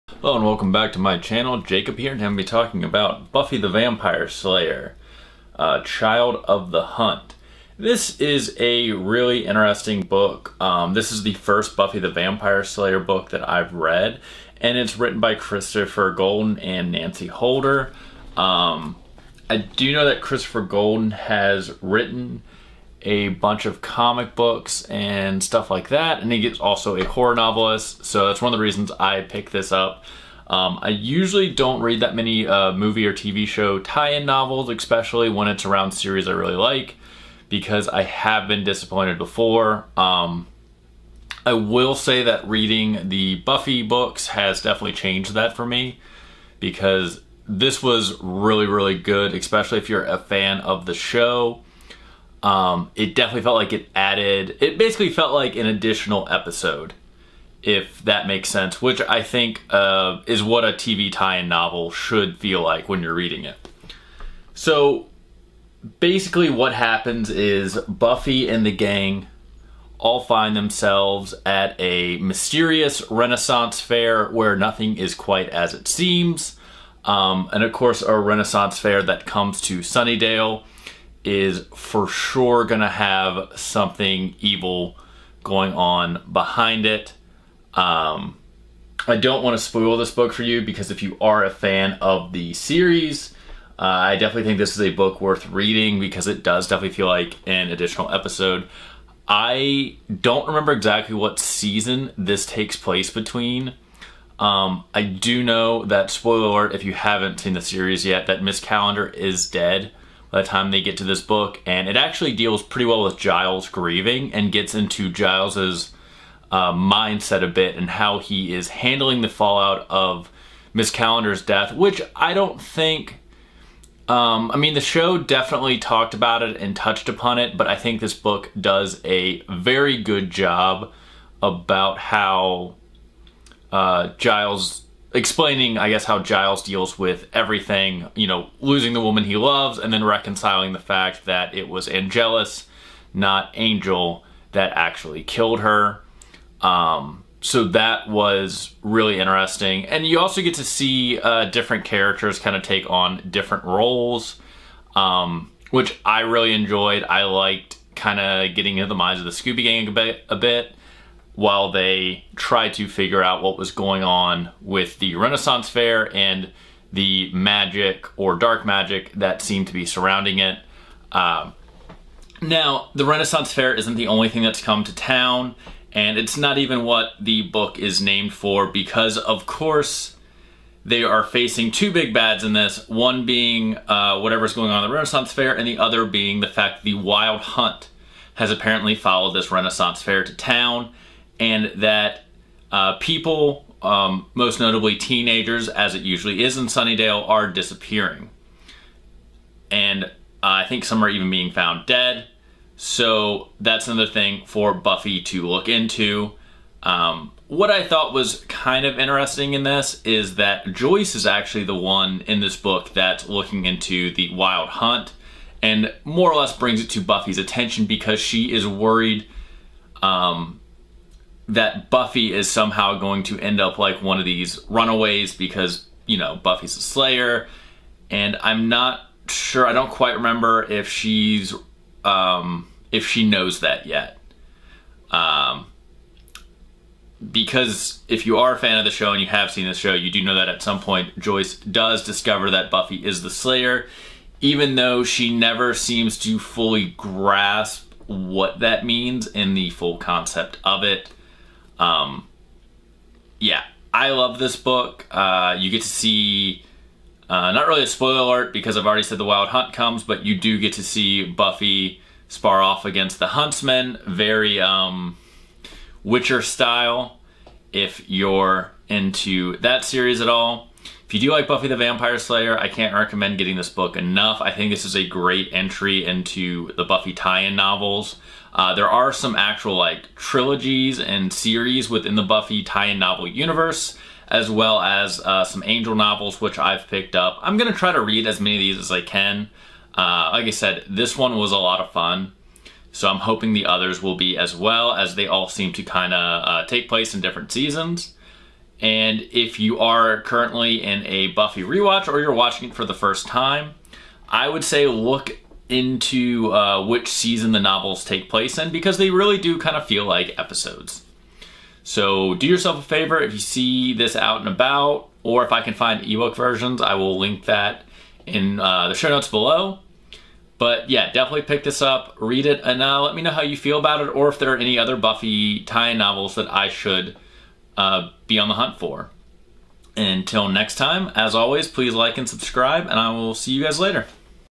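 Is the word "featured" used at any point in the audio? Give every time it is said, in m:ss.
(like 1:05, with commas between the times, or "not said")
not said.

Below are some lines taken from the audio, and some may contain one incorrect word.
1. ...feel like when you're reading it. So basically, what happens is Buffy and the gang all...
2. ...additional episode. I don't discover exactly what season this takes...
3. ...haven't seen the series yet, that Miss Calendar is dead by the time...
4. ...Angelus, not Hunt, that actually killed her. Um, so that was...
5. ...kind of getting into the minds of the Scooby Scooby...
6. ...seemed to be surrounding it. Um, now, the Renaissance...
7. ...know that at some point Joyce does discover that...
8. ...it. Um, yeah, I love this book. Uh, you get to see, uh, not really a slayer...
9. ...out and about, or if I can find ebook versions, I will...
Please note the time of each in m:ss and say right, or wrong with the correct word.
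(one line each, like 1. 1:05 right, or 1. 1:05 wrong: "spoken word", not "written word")
1. 1:02 right
2. 1:37 wrong: "remember", not "discover"
3. 1:46 right
4. 2:21 wrong: "Angel", not "Hunt"
5. 2:37 wrong: "Gang", not "Scooby"
6. 2:49 right
7. 4:00 right
8. 4:10 wrong: "spoiler", not "slayer"
9. 5:14 right.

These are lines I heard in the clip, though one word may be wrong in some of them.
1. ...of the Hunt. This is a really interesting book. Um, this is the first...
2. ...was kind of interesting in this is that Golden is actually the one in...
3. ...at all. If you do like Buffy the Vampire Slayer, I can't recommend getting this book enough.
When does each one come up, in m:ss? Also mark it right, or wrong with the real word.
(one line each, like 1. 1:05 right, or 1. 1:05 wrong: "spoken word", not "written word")
1. 0:06 right
2. 3:28 wrong: "Joyce", not "Golden"
3. 4:30 right.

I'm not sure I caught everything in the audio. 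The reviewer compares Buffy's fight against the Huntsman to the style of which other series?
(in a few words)
Witcher.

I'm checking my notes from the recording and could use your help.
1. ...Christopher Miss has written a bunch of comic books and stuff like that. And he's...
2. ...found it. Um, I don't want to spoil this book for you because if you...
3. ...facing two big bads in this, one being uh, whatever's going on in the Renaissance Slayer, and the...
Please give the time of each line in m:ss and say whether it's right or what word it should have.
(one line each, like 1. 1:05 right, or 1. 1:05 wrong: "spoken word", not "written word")
1. 0:20 wrong: "Golden", not "Miss"
2. 1:26 wrong: "behind", not "found"
3. 3:01 wrong: "Fair", not "Slayer".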